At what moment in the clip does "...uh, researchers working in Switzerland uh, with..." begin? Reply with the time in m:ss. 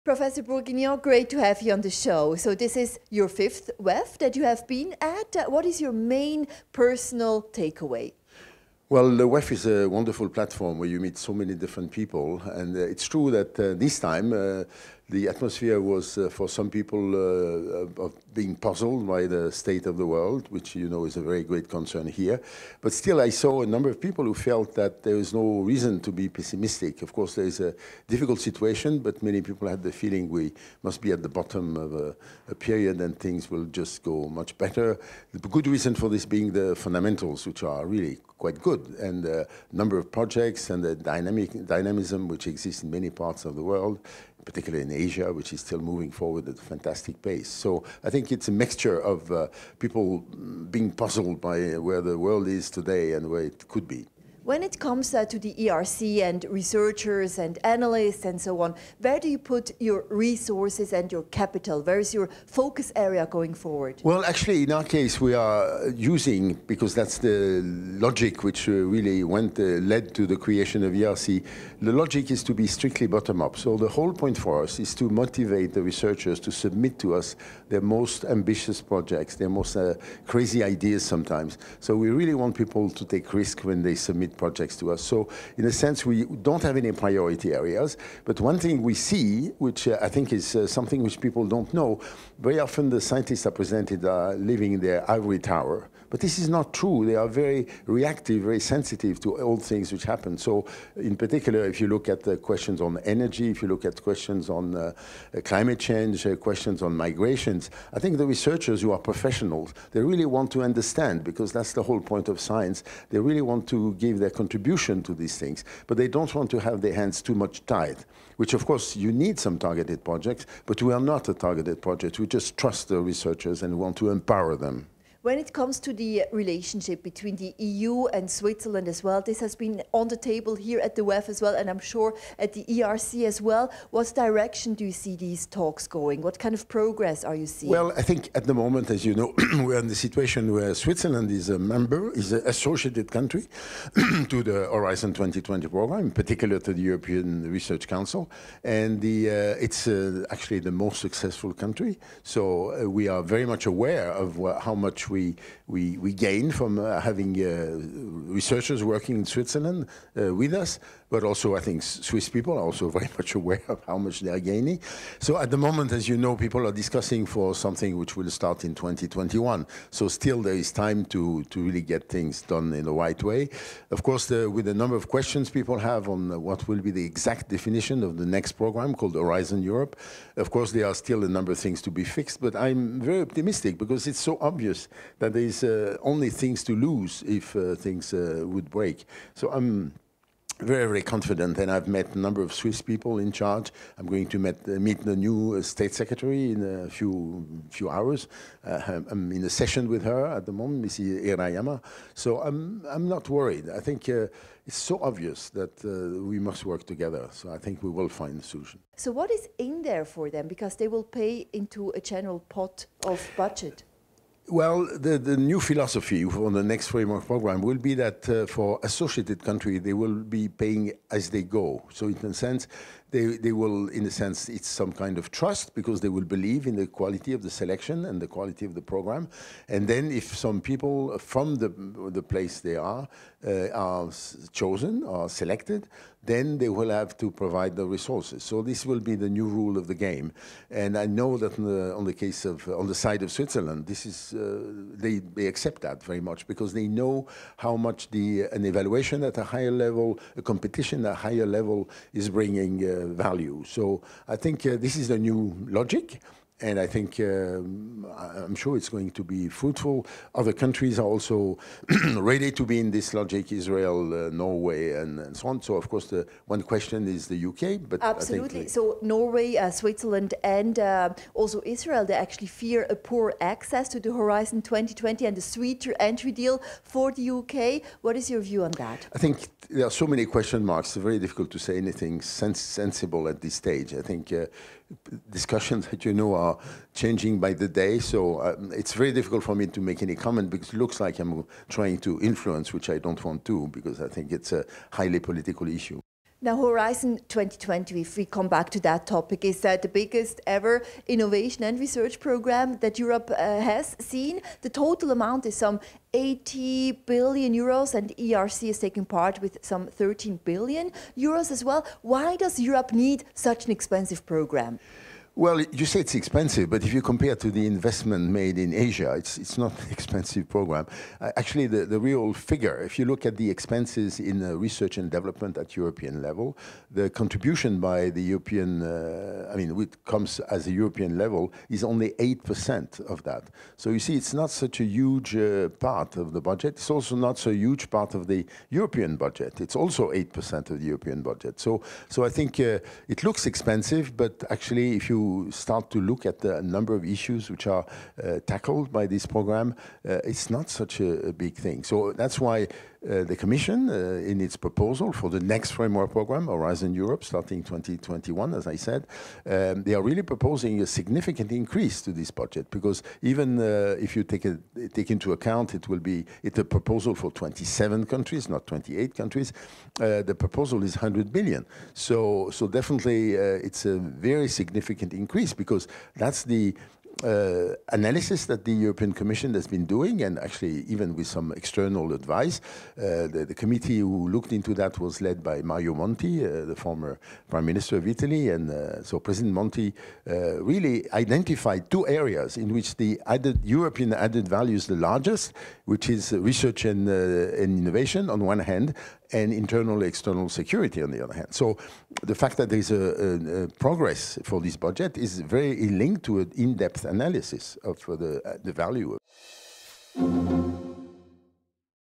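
2:37.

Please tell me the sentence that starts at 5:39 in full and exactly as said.
It's also 8% of the European budget.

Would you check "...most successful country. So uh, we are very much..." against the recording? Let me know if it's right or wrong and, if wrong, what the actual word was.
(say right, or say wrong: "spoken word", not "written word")
right.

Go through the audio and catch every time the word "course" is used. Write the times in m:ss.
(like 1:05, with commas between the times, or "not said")
0:27, 1:58, 2:54, 3:00, 4:25.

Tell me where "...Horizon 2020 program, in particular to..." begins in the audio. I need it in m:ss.
2:24.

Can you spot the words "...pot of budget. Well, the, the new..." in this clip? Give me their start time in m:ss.
3:32.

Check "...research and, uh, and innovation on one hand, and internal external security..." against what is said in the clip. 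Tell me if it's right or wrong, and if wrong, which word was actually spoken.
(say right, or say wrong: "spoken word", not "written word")
right.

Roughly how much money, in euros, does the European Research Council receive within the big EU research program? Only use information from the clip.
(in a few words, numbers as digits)
13 billion euros.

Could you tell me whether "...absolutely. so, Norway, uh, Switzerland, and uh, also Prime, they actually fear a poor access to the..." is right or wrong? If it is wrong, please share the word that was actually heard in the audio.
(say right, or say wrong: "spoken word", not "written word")
wrong: "Israel", not "Prime".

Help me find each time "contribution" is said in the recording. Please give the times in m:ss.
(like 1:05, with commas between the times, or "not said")
1:54, 5:27.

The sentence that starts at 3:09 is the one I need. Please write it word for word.
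So I'm very, very confident, and I've met a number of Swiss people in charge.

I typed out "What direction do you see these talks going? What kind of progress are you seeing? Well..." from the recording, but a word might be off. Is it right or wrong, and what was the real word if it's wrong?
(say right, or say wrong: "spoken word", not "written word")
right.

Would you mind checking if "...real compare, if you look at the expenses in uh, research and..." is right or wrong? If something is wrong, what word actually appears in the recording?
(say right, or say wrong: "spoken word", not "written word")
wrong: "figure", not "compare".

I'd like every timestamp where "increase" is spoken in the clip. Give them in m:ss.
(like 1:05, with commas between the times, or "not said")
6:01, 6:15.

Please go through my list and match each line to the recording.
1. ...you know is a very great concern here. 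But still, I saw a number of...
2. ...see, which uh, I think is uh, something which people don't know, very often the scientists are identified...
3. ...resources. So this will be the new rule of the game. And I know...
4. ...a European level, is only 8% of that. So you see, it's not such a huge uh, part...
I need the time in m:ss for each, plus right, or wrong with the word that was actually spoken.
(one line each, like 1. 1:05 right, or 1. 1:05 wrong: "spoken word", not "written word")
1. 0:20 right
2. 1:28 wrong: "presented", not "identified"
3. 3:57 right
4. 5:30 right.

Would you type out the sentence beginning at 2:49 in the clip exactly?
So still there is time to, to really get things done in the right way.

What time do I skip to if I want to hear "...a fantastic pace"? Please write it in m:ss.
0:46.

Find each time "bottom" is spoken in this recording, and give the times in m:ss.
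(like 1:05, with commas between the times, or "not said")
0:31, 1:13.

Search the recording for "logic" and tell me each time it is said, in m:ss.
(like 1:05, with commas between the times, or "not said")
1:07, 1:11, 4:15, 4:23.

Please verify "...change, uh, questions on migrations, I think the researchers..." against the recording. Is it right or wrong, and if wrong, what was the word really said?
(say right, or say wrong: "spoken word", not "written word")
right.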